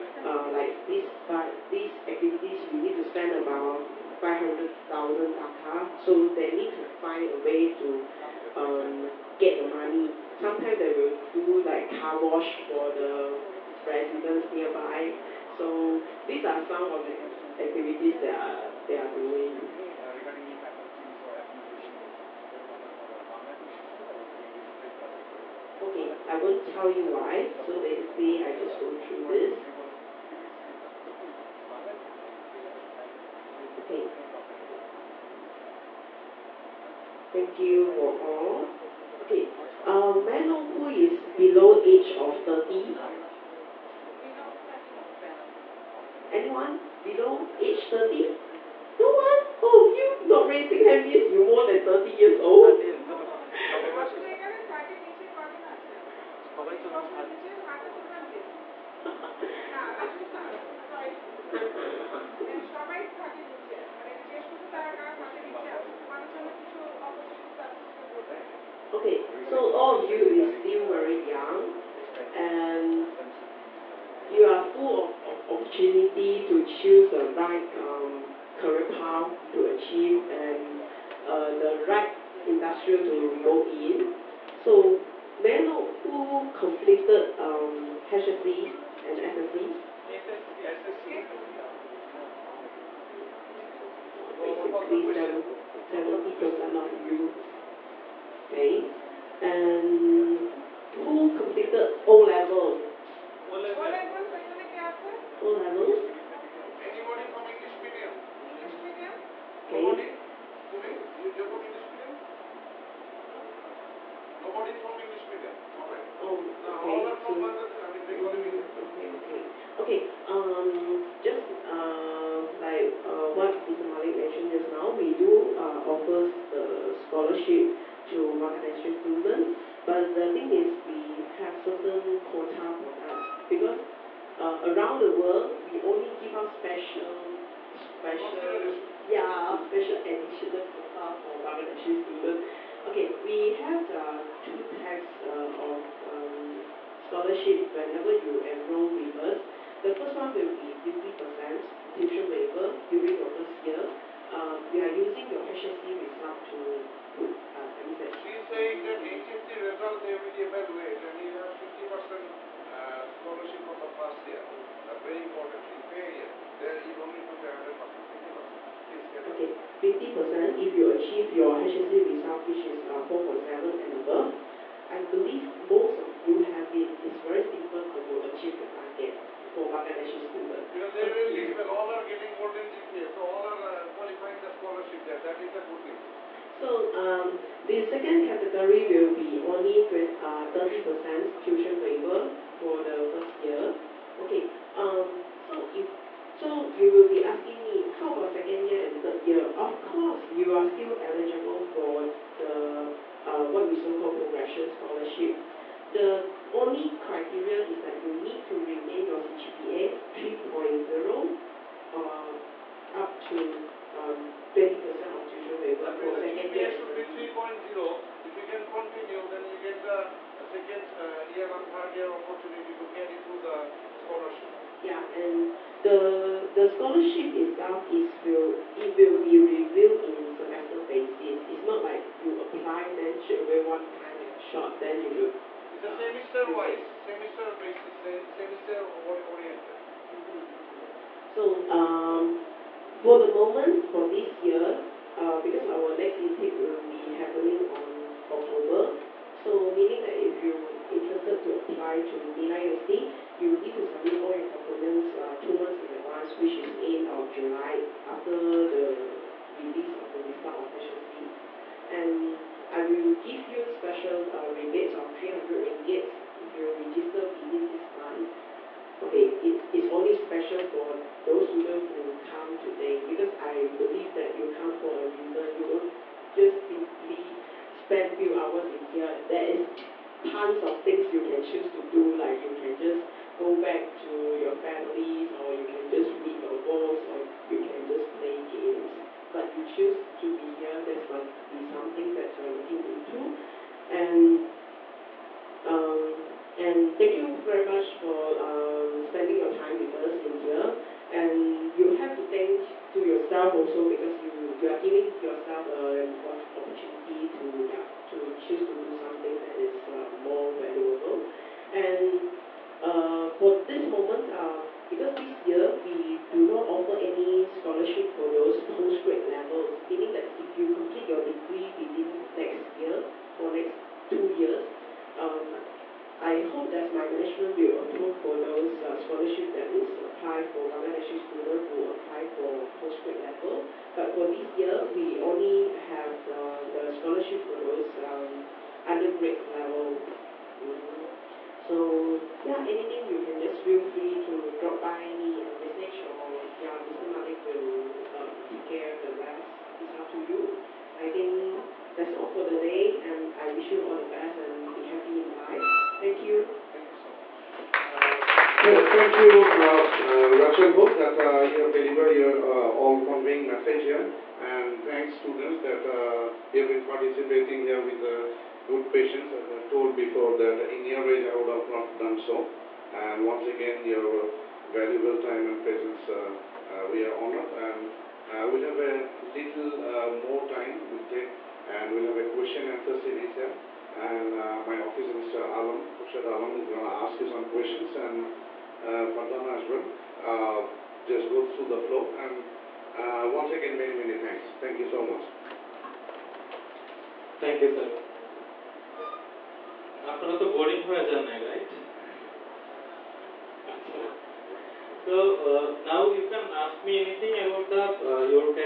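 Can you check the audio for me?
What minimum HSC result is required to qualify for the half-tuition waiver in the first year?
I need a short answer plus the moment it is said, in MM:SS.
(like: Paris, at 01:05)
4.7, at 02:53.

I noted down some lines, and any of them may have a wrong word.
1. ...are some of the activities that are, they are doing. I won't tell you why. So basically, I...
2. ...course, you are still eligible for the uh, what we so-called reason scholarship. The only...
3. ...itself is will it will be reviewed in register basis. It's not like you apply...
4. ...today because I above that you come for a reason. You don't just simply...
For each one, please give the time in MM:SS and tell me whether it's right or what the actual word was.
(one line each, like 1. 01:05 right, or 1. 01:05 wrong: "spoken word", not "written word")
1. 00:16 right
2. 03:19 wrong: "progression", not "reason"
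3. 03:47 wrong: "semester", not "register"
4. 04:32 wrong: "believe", not "above".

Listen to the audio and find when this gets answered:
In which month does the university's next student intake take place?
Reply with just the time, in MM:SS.
04:08.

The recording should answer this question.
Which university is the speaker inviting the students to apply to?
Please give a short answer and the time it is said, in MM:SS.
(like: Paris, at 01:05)
Nilai University, at 04:12.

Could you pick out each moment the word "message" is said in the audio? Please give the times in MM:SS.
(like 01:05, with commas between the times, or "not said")
05:45, 06:03.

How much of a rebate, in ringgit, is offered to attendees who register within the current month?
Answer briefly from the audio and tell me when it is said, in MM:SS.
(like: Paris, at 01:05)
300 ringgit, at 04:25.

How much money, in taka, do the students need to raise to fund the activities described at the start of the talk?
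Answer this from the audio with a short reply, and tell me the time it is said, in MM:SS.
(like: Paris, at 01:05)
500,000 taka, at 00:04.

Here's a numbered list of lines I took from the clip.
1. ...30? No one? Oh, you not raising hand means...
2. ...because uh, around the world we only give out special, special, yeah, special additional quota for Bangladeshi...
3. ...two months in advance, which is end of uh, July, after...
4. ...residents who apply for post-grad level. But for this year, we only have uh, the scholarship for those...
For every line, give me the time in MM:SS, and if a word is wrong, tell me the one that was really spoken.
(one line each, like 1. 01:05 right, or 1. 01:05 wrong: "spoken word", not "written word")
1. 00:47 right
2. 02:13 right
3. 04:15 right
4. 05:31 wrong: "students", not "residents".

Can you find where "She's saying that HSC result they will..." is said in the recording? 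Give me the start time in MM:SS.
02:38.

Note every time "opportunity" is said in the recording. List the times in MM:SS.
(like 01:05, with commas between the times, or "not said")
01:15, 03:42, 05:06.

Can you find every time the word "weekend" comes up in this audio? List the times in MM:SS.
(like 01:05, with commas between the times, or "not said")
not said.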